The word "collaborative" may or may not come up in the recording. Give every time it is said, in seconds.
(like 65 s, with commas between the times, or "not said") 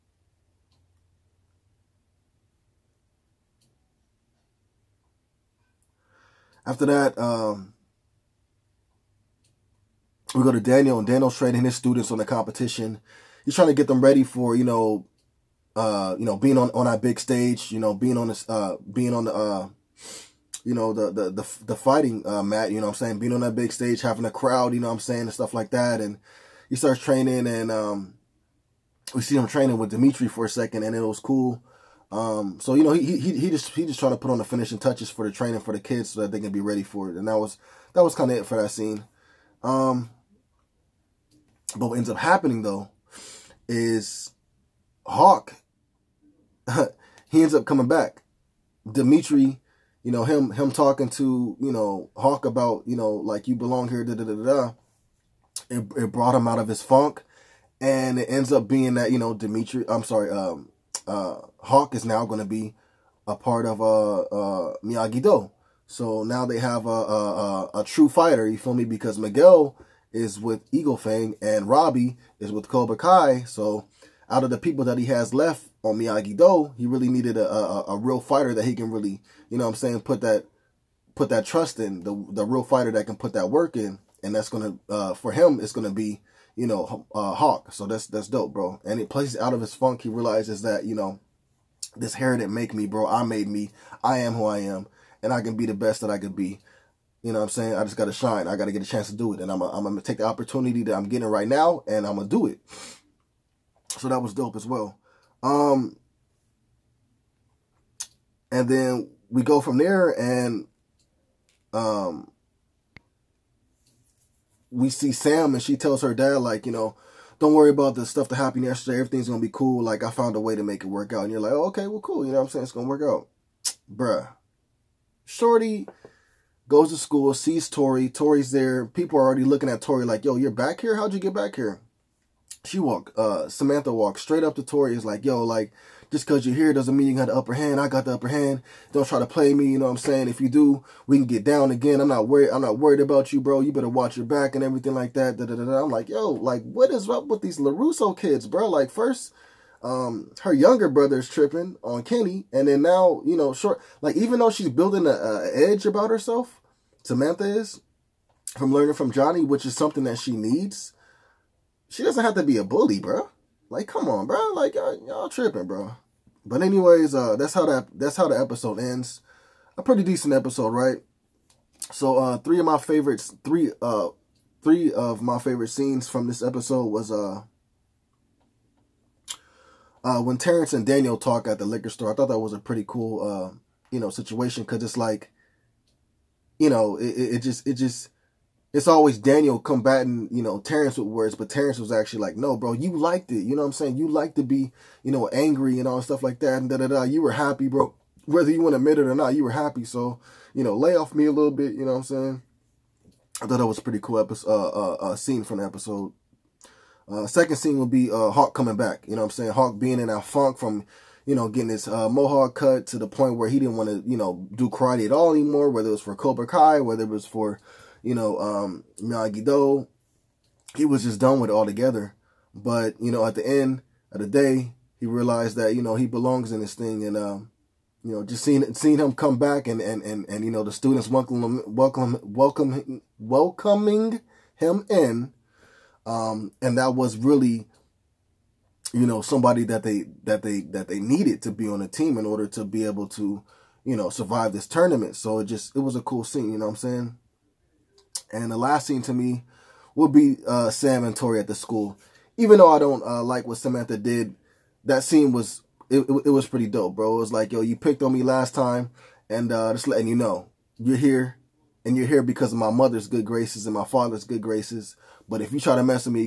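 not said.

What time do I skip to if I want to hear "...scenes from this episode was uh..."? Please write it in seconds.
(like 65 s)
175 s.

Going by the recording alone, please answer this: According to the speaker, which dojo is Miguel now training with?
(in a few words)
Eagle Fang.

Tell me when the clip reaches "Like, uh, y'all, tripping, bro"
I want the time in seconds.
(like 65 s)
164 s.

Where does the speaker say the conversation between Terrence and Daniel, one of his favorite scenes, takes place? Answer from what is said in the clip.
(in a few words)
liquor store.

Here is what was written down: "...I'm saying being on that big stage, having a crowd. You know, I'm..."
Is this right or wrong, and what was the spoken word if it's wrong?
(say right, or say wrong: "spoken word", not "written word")
right.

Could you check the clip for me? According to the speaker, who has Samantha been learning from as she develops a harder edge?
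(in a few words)
Johnny.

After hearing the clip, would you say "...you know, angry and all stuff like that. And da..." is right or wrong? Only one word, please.
right.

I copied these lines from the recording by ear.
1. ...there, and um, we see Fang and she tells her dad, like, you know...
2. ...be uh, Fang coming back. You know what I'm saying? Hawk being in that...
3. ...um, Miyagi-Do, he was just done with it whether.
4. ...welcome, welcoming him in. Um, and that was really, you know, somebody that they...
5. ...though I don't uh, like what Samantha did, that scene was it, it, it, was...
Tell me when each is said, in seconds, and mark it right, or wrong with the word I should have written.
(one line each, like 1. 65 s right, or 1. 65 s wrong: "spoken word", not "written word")
1. 109 s wrong: "Sam", not "Fang"
2. 207 s wrong: "Hawk", not "Fang"
3. 218 s wrong: "altogether", not "whether"
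4. 232 s right
5. 252 s right.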